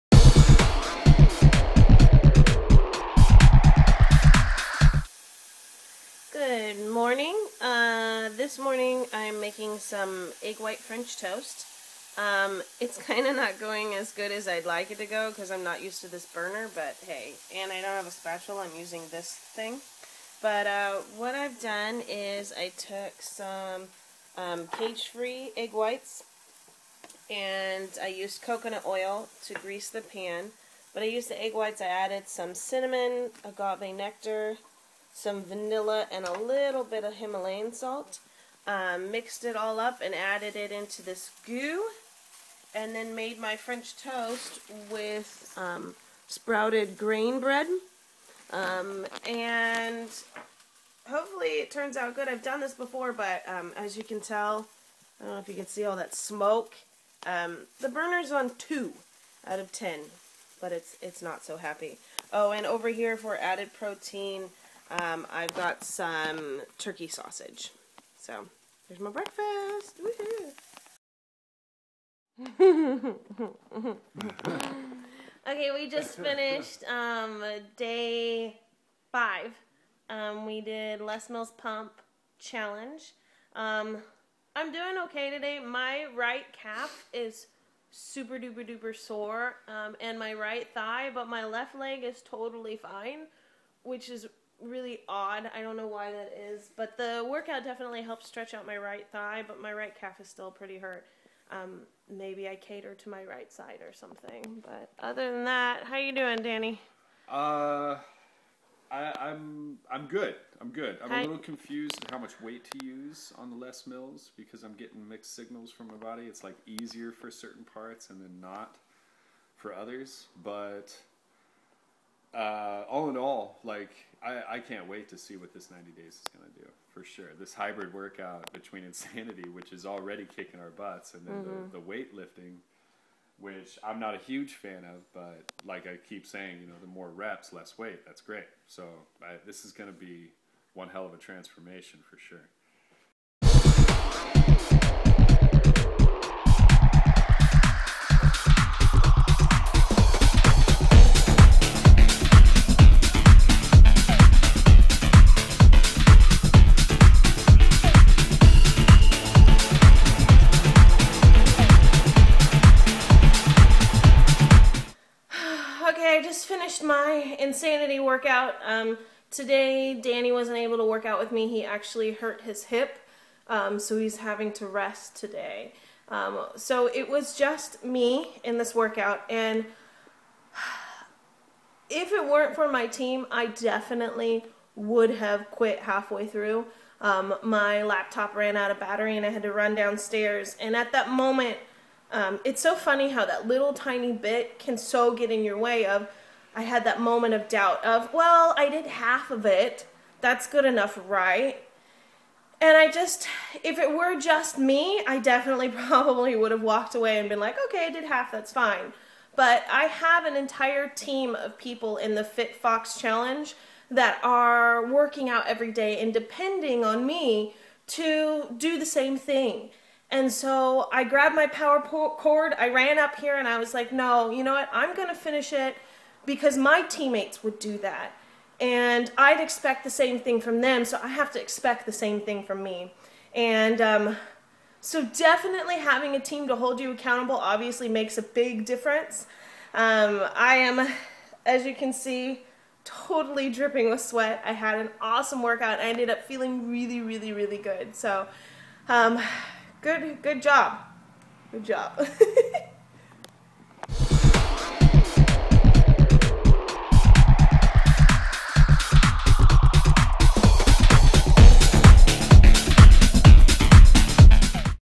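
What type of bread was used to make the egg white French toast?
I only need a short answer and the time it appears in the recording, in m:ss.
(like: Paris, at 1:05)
sprouted grain bread, at 0:46.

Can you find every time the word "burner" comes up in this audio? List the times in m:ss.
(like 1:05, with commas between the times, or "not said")
0:16, 0:57.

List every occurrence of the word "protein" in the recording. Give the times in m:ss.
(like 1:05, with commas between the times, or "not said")
1:03.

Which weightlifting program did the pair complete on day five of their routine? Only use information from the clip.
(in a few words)
Les Mills Pump Challenge.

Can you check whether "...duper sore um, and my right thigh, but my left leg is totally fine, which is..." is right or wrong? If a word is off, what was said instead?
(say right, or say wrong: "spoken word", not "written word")
right.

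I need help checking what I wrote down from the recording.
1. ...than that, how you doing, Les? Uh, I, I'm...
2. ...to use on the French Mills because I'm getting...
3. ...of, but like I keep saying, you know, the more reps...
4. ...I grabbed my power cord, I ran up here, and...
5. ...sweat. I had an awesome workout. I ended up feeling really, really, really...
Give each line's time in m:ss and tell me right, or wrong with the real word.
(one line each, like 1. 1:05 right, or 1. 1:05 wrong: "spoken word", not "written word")
1. 1:45 wrong: "Danny", not "Les"
2. 1:52 wrong: "Les", not "French"
3. 2:14 right
4. 3:40 right
5. 4:04 right.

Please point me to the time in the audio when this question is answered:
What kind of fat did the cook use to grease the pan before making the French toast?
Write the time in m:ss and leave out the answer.
0:28.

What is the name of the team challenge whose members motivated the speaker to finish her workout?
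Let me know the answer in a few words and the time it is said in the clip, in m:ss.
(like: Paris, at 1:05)
Fit Fox Challenge, at 3:32.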